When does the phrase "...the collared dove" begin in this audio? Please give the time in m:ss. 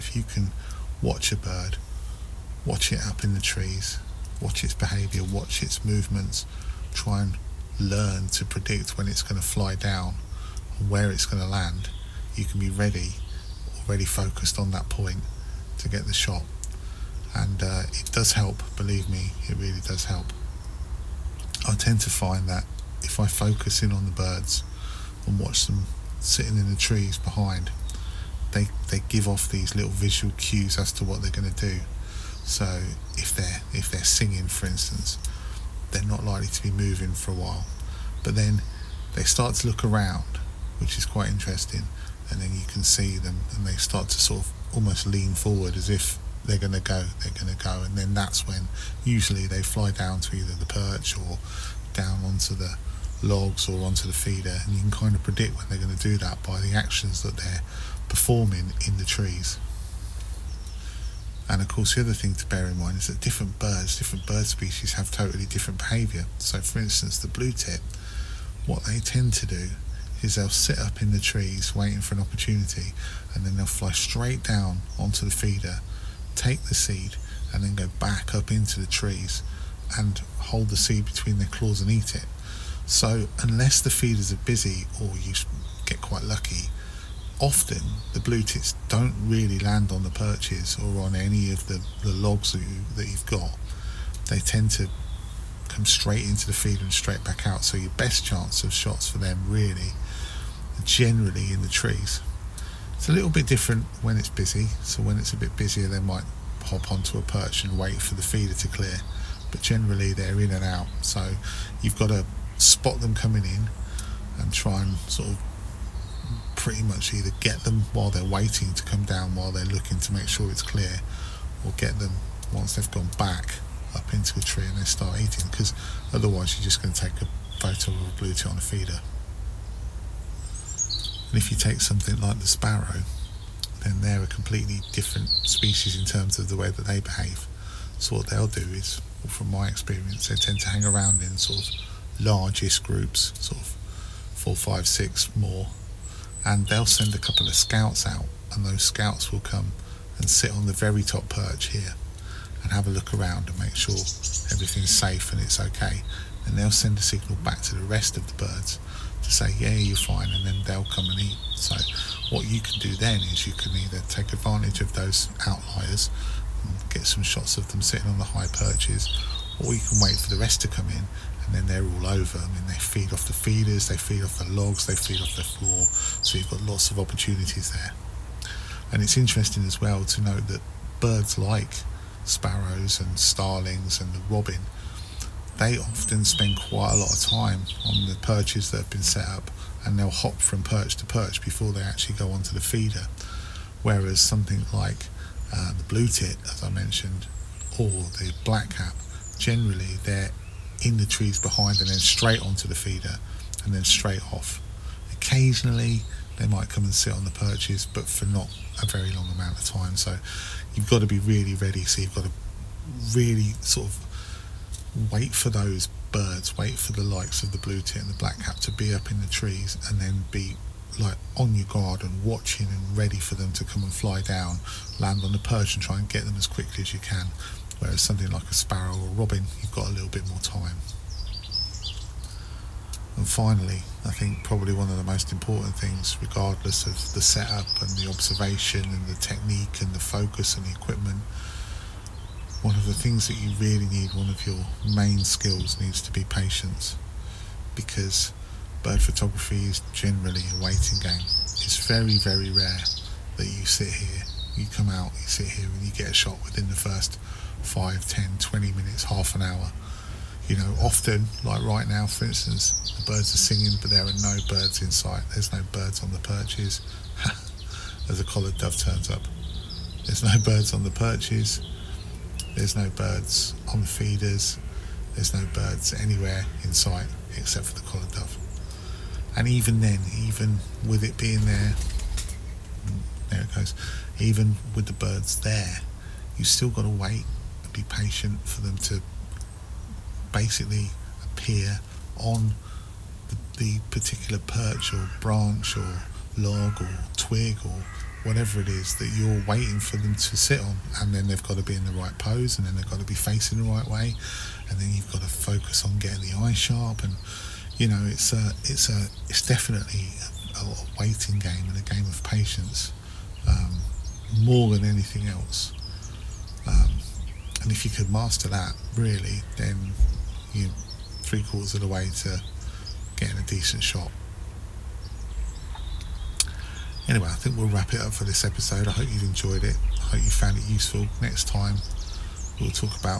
4:37.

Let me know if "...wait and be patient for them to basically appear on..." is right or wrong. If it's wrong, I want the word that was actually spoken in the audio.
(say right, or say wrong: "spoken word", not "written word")
right.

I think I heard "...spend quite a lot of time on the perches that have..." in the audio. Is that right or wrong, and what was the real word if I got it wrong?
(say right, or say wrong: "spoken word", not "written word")
right.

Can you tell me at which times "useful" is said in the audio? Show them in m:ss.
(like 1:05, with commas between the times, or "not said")
5:30.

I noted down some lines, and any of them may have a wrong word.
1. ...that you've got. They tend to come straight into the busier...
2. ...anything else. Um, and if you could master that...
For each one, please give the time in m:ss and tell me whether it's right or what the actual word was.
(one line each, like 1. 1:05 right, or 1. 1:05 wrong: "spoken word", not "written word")
1. 1:32 wrong: "feeder", not "busier"
2. 5:14 right.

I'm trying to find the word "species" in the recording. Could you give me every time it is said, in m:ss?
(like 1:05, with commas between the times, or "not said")
1:04, 2:15.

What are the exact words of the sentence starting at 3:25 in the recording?
Occasionally they might come and sit on the perches, but for not a very long amount of time.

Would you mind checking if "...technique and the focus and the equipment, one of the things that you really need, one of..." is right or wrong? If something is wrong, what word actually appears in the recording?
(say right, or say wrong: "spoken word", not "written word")
right.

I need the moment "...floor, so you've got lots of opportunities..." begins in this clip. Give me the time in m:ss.
2:55.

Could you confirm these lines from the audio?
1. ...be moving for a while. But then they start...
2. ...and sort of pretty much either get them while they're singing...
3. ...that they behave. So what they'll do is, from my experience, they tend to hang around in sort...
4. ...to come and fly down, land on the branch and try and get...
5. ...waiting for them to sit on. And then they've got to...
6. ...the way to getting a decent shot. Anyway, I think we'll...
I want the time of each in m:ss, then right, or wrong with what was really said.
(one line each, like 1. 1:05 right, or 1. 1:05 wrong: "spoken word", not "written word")
1. 0:36 right
2. 1:54 wrong: "waiting", not "singing"
3. 2:16 right
4. 3:43 wrong: "perch", not "branch"
5. 4:59 right
6. 5:21 right.